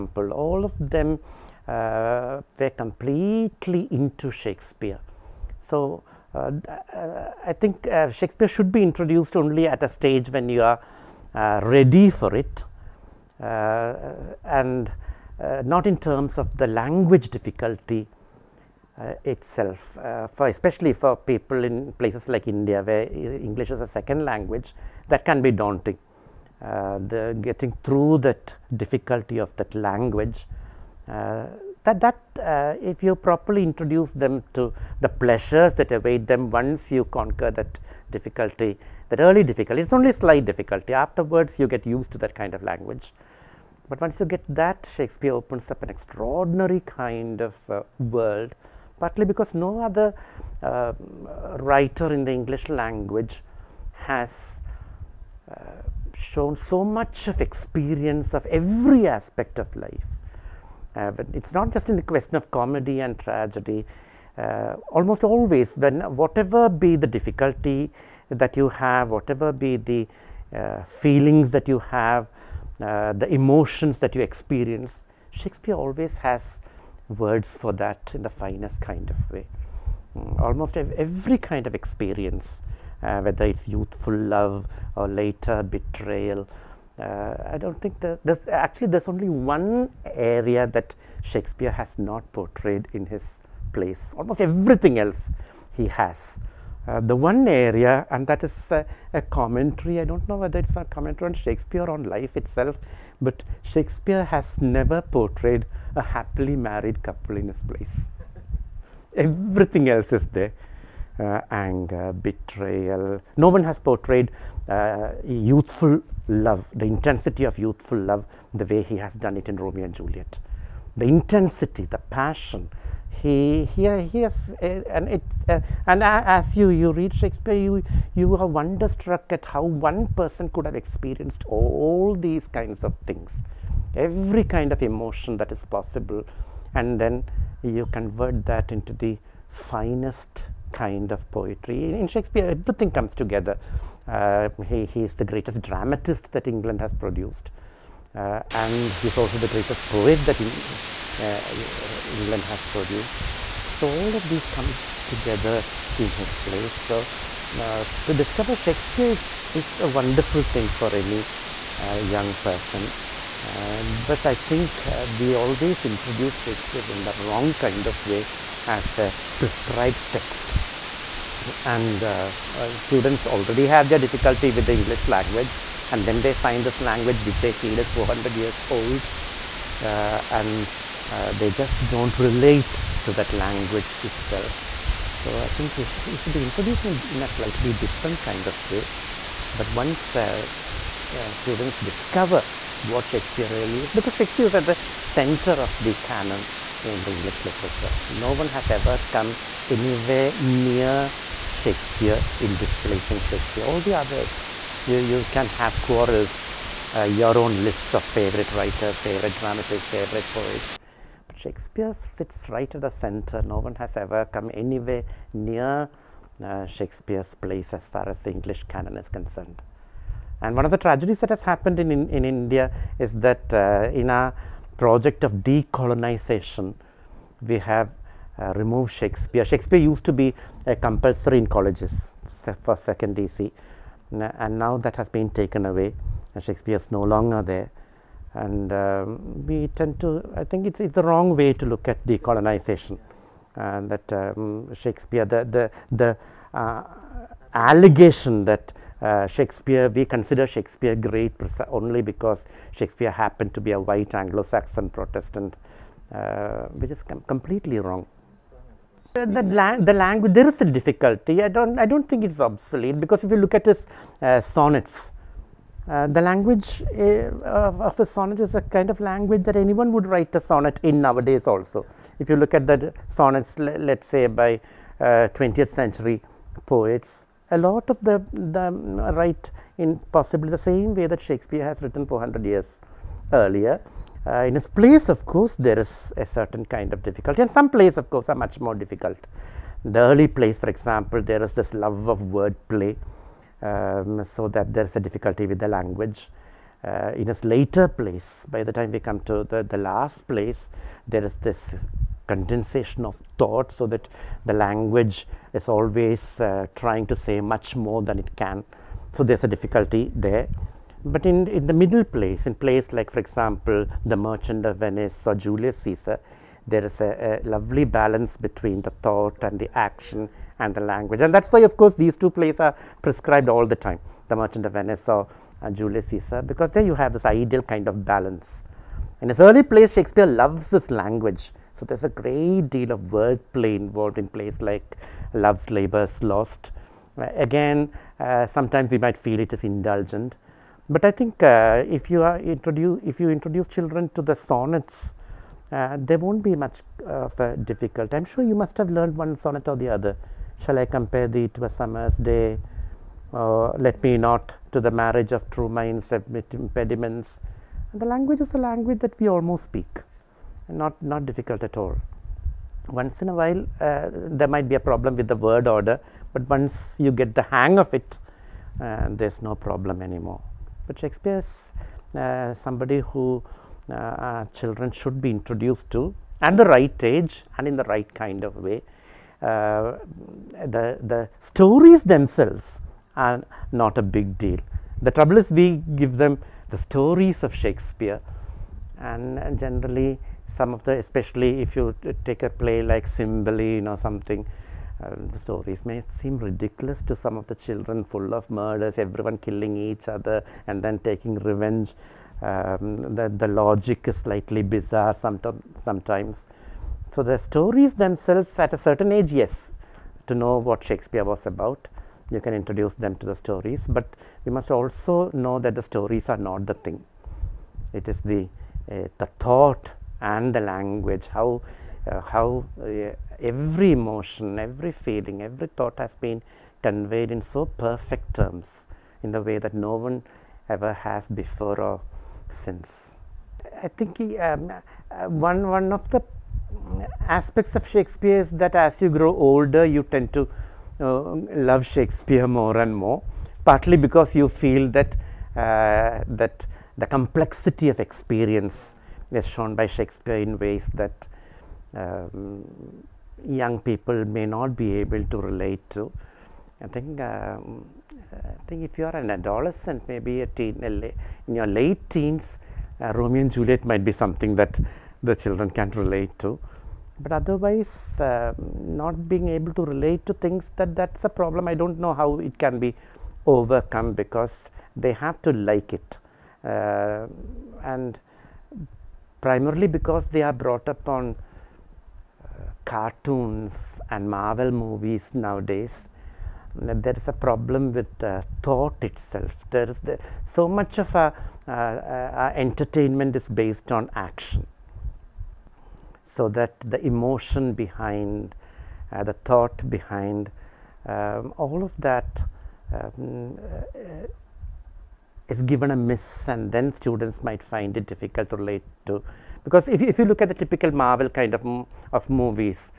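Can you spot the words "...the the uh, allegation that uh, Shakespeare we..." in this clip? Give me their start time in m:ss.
4:05.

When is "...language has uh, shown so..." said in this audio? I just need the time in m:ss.
0:52.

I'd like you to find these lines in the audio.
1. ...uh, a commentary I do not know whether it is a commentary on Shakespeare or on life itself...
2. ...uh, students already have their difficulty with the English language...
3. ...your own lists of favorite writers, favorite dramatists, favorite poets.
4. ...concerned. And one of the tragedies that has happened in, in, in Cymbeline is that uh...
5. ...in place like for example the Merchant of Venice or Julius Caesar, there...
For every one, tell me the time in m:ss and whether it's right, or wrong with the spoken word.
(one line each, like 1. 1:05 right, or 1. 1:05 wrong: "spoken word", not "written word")
1. 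1:38 right
2. 2:52 right
3. 3:27 right
4. 3:39 wrong: "India", not "Cymbeline"
5. 5:12 right.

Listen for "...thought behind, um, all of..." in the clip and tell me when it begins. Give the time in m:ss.
8:19.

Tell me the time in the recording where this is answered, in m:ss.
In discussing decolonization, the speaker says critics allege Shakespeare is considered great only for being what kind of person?
4:13.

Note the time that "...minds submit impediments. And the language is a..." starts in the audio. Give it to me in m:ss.
5:55.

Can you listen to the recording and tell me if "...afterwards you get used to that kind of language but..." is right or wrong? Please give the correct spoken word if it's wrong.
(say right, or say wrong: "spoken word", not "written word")
right.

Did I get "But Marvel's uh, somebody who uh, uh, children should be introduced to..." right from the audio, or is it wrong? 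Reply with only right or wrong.
wrong.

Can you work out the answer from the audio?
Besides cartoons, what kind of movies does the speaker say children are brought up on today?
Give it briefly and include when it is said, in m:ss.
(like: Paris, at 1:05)
Marvel movies, at 8:04.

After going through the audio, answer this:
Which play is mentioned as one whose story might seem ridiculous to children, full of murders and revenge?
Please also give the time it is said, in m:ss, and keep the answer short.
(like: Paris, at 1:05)
Cymbeline, at 6:33.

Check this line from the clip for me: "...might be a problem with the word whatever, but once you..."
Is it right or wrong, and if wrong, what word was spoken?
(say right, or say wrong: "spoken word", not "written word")
wrong: "order", not "whatever".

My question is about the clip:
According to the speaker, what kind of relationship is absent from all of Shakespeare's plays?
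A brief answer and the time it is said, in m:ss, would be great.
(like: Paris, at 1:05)
A happily married couple, at 1:45.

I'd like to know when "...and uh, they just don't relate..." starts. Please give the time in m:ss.
3:00.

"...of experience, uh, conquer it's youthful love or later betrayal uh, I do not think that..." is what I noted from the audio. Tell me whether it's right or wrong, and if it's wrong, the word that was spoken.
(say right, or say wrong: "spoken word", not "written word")
wrong: "whether", not "conquer".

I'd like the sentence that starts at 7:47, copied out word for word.
But otherwise, uh, not being able to relate to things that that's a problem.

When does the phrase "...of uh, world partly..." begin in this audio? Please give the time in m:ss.
0:47.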